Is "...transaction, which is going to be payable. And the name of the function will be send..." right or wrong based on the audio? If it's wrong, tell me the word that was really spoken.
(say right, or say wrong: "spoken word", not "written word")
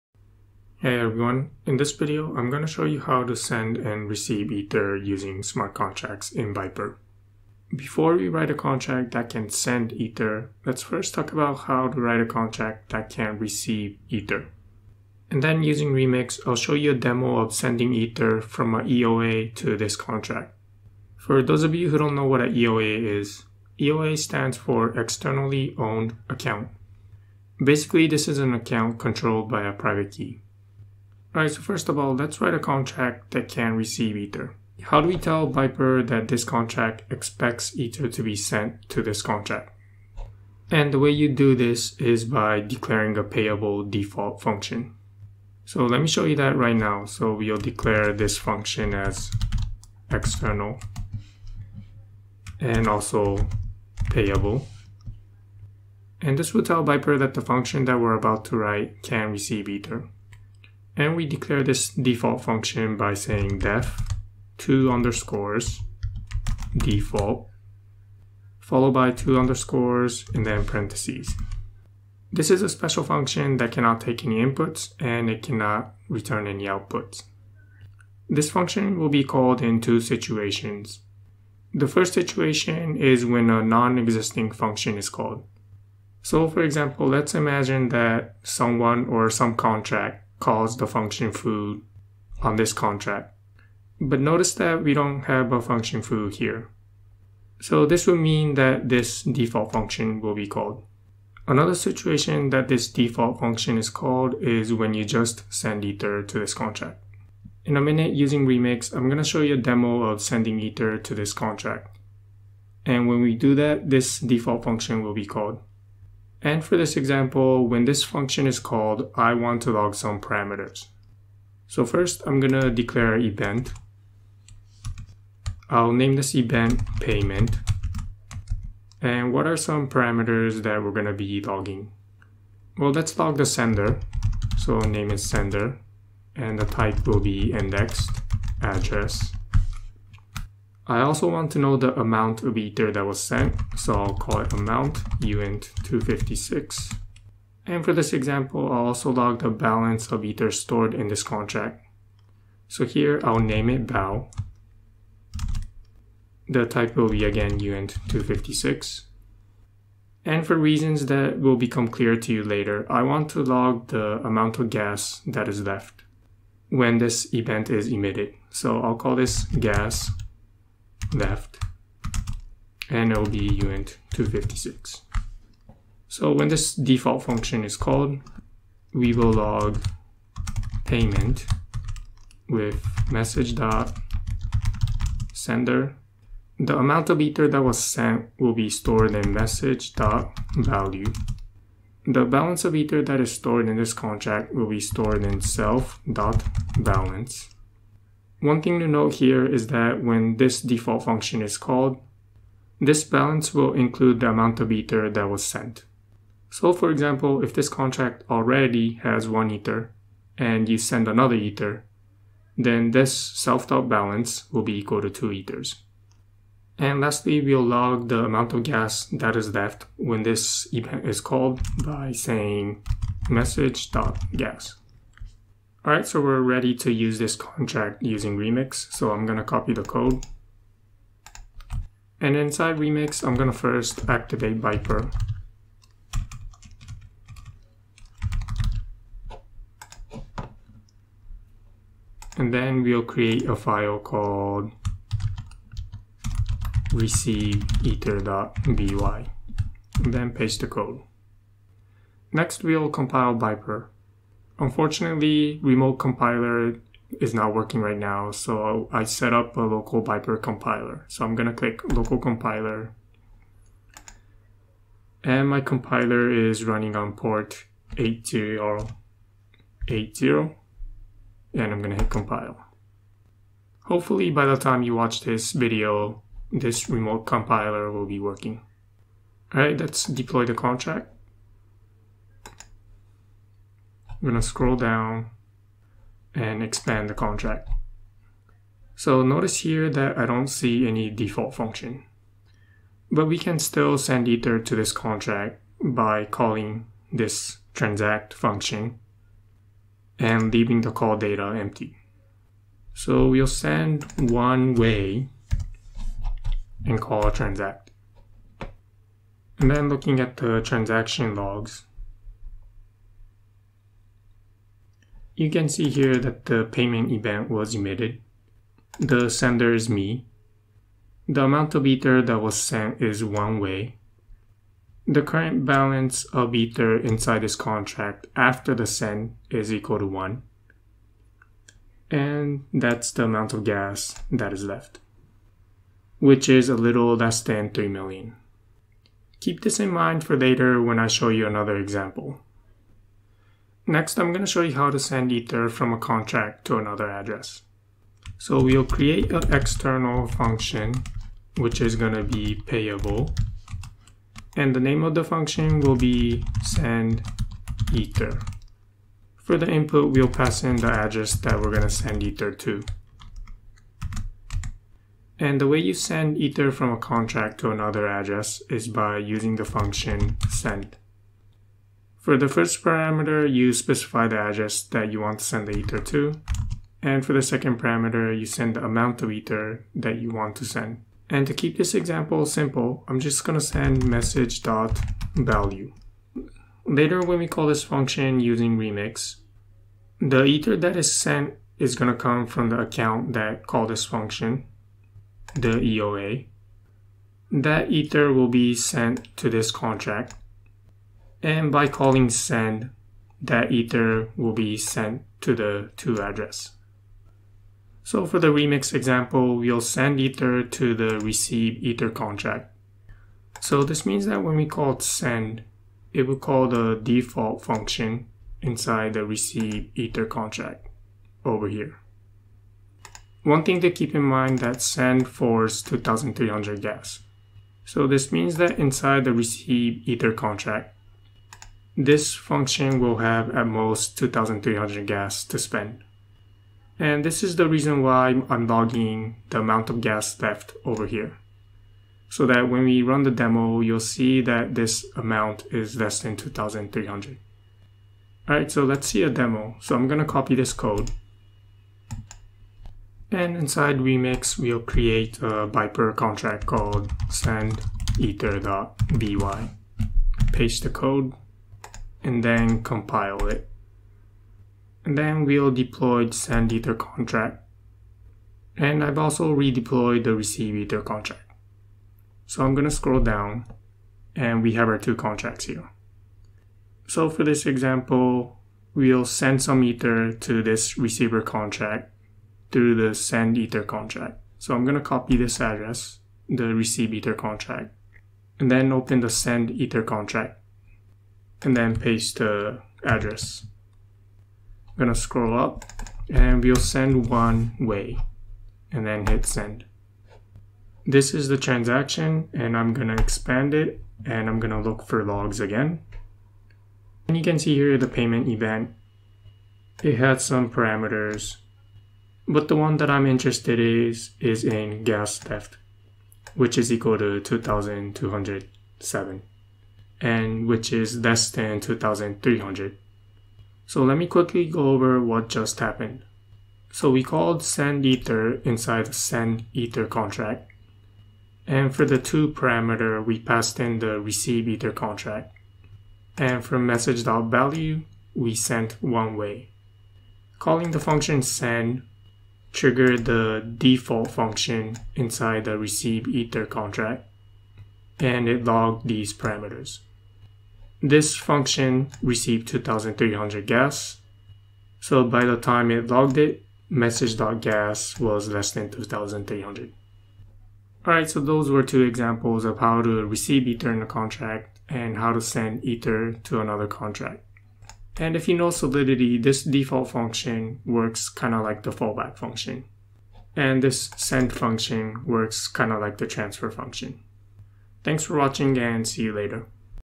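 wrong: "function", not "transaction".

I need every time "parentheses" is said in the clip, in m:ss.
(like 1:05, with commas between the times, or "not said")
1:10.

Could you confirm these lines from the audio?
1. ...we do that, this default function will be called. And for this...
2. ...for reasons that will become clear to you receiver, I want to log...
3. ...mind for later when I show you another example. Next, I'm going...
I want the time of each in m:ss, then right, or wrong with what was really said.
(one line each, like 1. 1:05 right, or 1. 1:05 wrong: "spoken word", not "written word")
1. 1:53 right
2. 2:40 wrong: "later", not "receiver"
3. 5:39 right.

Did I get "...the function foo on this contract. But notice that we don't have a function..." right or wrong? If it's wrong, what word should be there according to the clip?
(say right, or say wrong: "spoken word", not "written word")
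right.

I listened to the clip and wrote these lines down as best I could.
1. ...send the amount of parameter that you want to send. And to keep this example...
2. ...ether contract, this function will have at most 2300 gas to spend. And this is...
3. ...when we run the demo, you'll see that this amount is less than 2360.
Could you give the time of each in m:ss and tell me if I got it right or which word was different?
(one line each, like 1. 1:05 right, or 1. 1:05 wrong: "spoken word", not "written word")
1. 6:18 wrong: "ether", not "parameter"
2. 7:10 right
3. 7:22 wrong: "2300", not "2360".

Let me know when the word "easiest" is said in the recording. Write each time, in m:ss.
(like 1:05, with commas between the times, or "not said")
not said.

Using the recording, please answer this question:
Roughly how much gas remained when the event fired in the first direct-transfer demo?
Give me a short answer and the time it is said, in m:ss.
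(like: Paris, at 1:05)
a little less than 3 million, at 5:36.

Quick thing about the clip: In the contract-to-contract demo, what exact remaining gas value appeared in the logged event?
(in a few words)
2207.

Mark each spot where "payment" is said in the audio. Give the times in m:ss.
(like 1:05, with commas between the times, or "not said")
2:06, 3:00, 5:16, 8:28.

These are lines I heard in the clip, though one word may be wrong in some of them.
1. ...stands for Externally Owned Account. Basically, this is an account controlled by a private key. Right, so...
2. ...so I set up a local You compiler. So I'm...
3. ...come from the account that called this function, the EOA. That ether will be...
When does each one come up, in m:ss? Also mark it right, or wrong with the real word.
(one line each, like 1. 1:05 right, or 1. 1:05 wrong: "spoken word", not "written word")
1. 0:24 right
2. 4:18 wrong: "Vyper", not "You"
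3. 6:32 right.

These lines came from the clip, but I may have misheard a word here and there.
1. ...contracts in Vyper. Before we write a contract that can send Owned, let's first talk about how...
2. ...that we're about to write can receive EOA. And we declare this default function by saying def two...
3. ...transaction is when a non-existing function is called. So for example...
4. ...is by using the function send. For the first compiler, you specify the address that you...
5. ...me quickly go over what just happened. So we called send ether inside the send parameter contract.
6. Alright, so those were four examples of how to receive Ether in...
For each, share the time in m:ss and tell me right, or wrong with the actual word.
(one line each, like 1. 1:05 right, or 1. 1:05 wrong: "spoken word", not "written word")
1. 0:05 wrong: "Ether", not "Owned"
2. 0:57 wrong: "Ether", not "EOA"
3. 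1:22 wrong: "situation", not "transaction"
4. 6:08 wrong: "parameter", not "compiler"
5. 8:44 wrong: "ether", not "parameter"
6. 9:21 wrong: "two", not "four".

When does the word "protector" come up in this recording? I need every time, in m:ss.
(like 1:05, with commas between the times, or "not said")
not said.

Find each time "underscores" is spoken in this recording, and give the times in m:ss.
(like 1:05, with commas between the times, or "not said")
1:04, 1:09.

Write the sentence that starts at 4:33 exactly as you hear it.
Hopefully by the time you watch this video, this remote compiler will be working.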